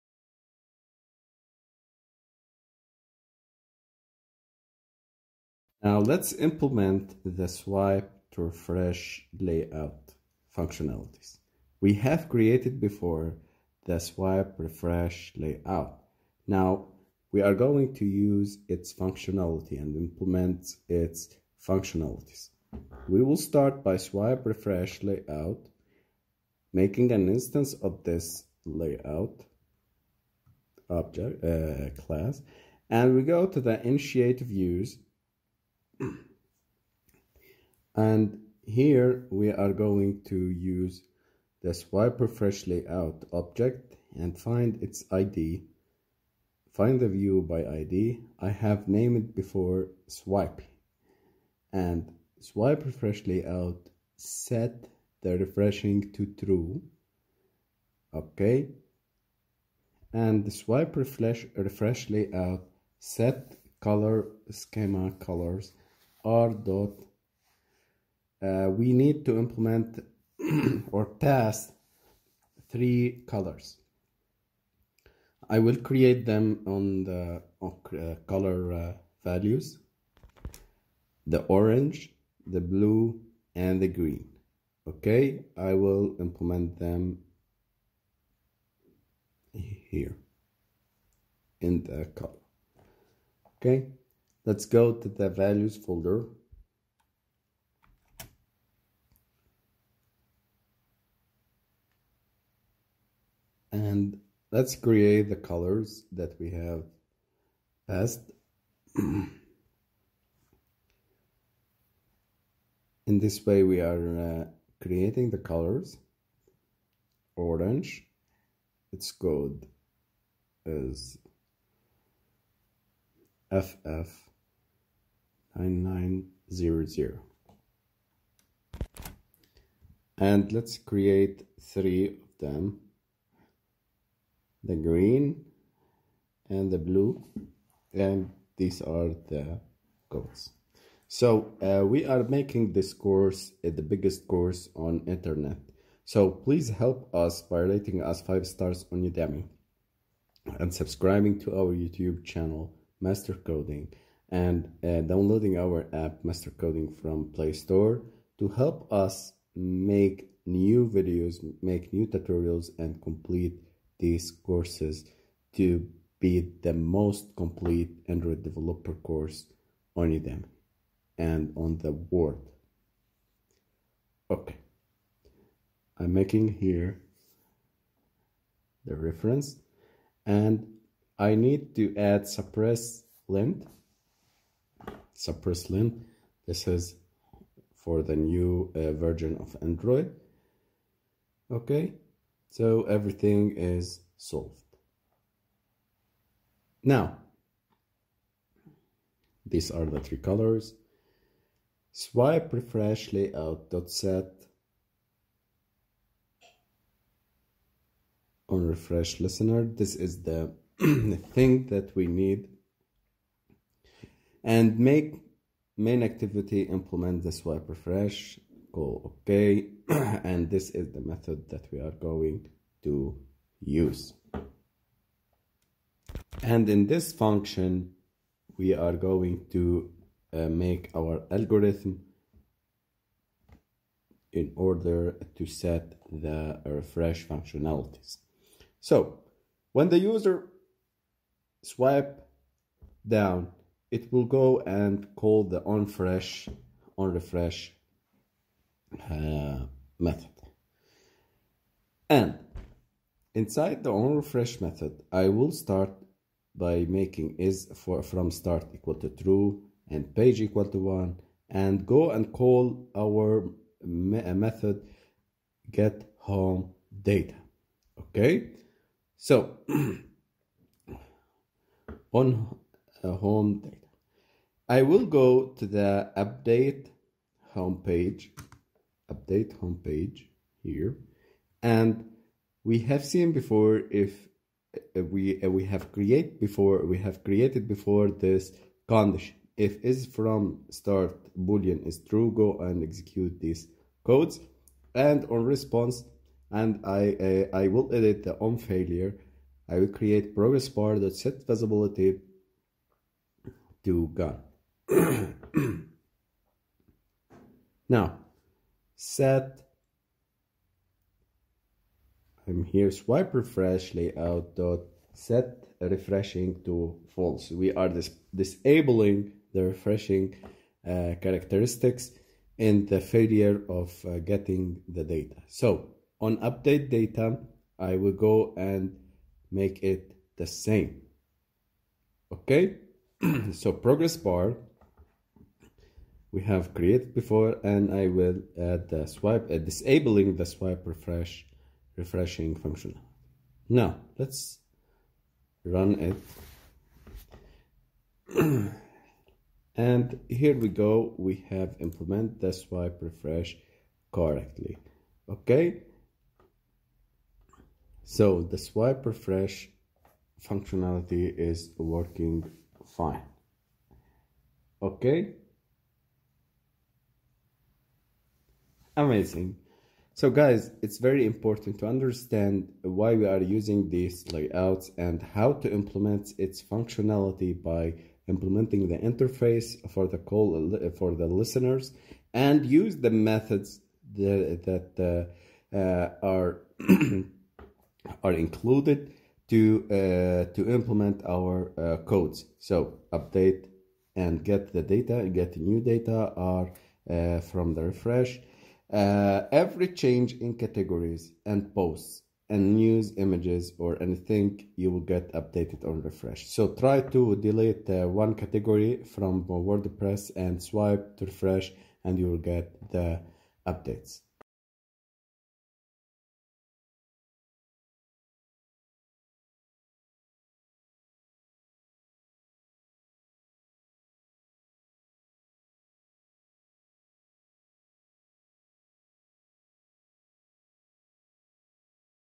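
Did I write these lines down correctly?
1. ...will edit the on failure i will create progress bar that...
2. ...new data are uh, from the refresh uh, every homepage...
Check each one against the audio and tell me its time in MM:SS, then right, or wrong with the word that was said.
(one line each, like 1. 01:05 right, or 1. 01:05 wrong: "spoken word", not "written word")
1. 04:57 right
2. 06:35 wrong: "change", not "homepage".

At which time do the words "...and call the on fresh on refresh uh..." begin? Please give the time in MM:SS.
04:04.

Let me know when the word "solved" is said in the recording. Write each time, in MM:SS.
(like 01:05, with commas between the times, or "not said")
03:14.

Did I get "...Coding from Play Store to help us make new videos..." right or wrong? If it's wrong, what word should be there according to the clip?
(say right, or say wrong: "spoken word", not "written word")
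right.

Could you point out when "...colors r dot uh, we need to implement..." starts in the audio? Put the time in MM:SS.
01:05.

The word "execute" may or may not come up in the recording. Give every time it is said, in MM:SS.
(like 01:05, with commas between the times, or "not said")
04:52.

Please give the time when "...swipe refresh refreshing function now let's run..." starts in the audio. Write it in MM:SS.
05:40.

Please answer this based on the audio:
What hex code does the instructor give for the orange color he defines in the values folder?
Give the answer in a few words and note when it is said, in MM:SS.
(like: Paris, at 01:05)
FF9900, at 02:03.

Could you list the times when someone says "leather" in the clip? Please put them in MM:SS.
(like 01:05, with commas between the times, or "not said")
not said.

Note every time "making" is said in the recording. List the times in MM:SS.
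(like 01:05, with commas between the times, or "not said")
00:26, 02:22, 02:56, 04:16.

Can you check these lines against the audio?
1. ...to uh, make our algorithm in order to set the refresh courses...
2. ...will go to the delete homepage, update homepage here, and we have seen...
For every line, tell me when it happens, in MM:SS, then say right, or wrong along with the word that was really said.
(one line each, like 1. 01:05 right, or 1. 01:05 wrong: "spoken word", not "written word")
1. 03:49 wrong: "functionalities", not "courses"
2. 04:34 wrong: "update", not "delete".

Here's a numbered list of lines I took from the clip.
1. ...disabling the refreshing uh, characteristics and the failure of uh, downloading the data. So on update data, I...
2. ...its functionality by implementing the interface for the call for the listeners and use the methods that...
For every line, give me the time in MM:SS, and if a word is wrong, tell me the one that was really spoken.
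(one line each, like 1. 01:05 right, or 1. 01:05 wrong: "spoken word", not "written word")
1. 05:18 wrong: "getting", not "downloading"
2. 06:16 right.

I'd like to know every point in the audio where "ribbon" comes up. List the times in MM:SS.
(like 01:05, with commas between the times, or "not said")
not said.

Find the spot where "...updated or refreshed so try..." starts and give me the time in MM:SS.
06:45.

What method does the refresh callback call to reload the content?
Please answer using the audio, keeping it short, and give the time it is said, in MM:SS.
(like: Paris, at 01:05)
get home data, at 04:25.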